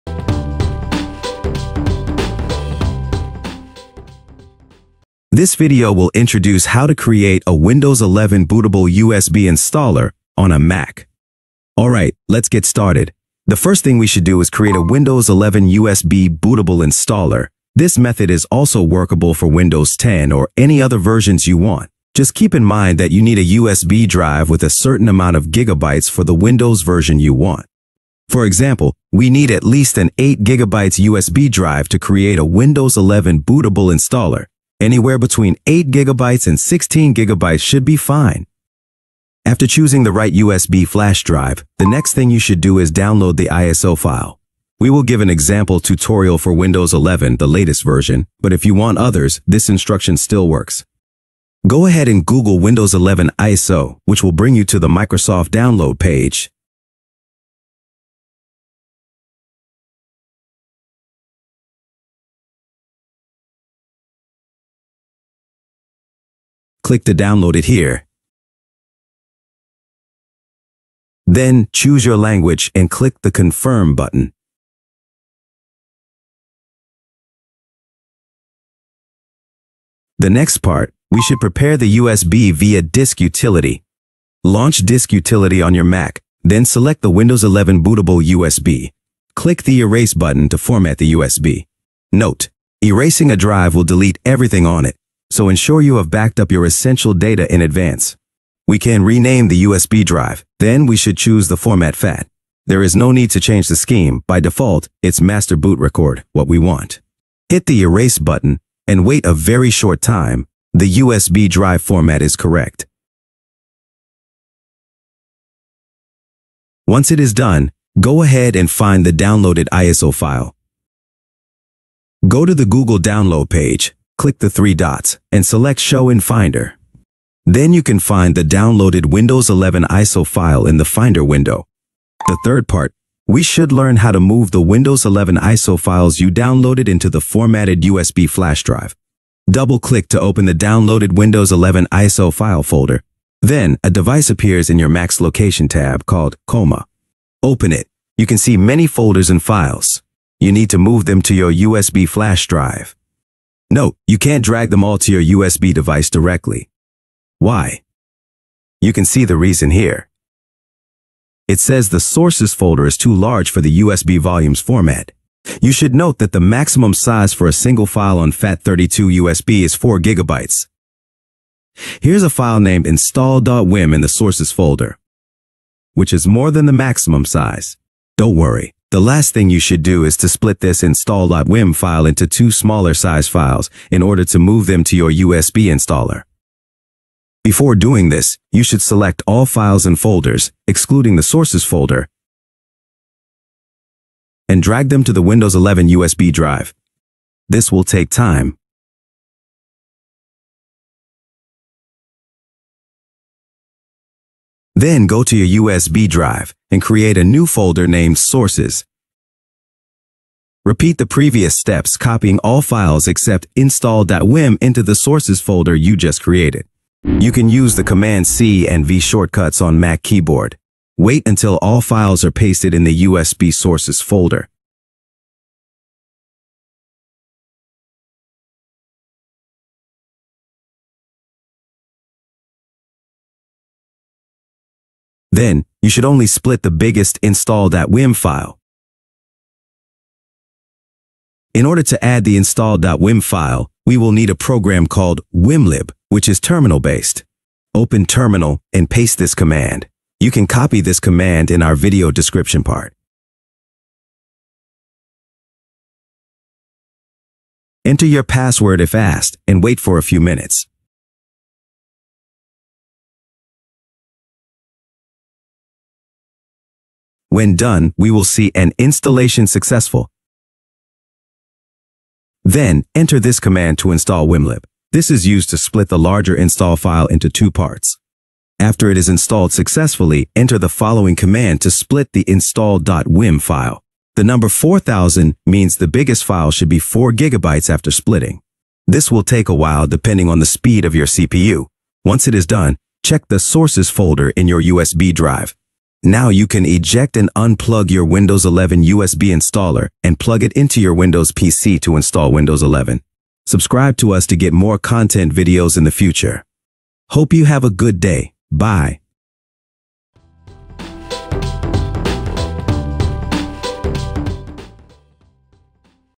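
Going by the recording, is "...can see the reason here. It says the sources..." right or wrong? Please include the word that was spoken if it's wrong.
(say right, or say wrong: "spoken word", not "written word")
right.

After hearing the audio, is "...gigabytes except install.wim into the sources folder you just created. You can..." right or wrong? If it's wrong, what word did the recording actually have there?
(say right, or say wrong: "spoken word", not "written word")
wrong: "files", not "gigabytes".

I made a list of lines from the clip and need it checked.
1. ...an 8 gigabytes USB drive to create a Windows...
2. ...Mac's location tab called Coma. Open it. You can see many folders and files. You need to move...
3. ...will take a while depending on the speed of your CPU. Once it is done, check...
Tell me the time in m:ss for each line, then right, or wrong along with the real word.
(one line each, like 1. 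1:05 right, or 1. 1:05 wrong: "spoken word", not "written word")
1. 0:29 right
2. 2:24 right
3. 4:49 right.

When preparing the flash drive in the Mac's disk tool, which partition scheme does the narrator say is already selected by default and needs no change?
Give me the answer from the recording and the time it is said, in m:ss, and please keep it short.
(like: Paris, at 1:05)
master boot record, at 1:45.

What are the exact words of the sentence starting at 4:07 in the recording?
Open terminal and paste this command.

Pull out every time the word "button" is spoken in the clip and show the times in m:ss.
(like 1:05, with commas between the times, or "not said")
1:13, 1:30, 1:48.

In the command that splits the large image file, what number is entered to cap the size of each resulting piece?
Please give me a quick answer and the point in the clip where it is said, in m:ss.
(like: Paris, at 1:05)
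4000, at 4:44.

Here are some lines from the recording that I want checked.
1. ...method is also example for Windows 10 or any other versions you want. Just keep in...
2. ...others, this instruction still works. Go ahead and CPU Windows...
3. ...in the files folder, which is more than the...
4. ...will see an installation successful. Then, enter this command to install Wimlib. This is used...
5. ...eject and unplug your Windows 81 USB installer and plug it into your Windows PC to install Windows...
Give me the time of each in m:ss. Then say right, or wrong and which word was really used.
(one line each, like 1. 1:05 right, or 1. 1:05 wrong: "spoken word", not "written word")
1. 0:17 wrong: "workable", not "example"
2. 0:48 wrong: "Google", not "CPU"
3. 2:53 wrong: "sources", not "files"
4. 4:28 right
5. 4:56 wrong: "11", not "81".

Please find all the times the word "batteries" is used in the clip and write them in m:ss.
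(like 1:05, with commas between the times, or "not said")
not said.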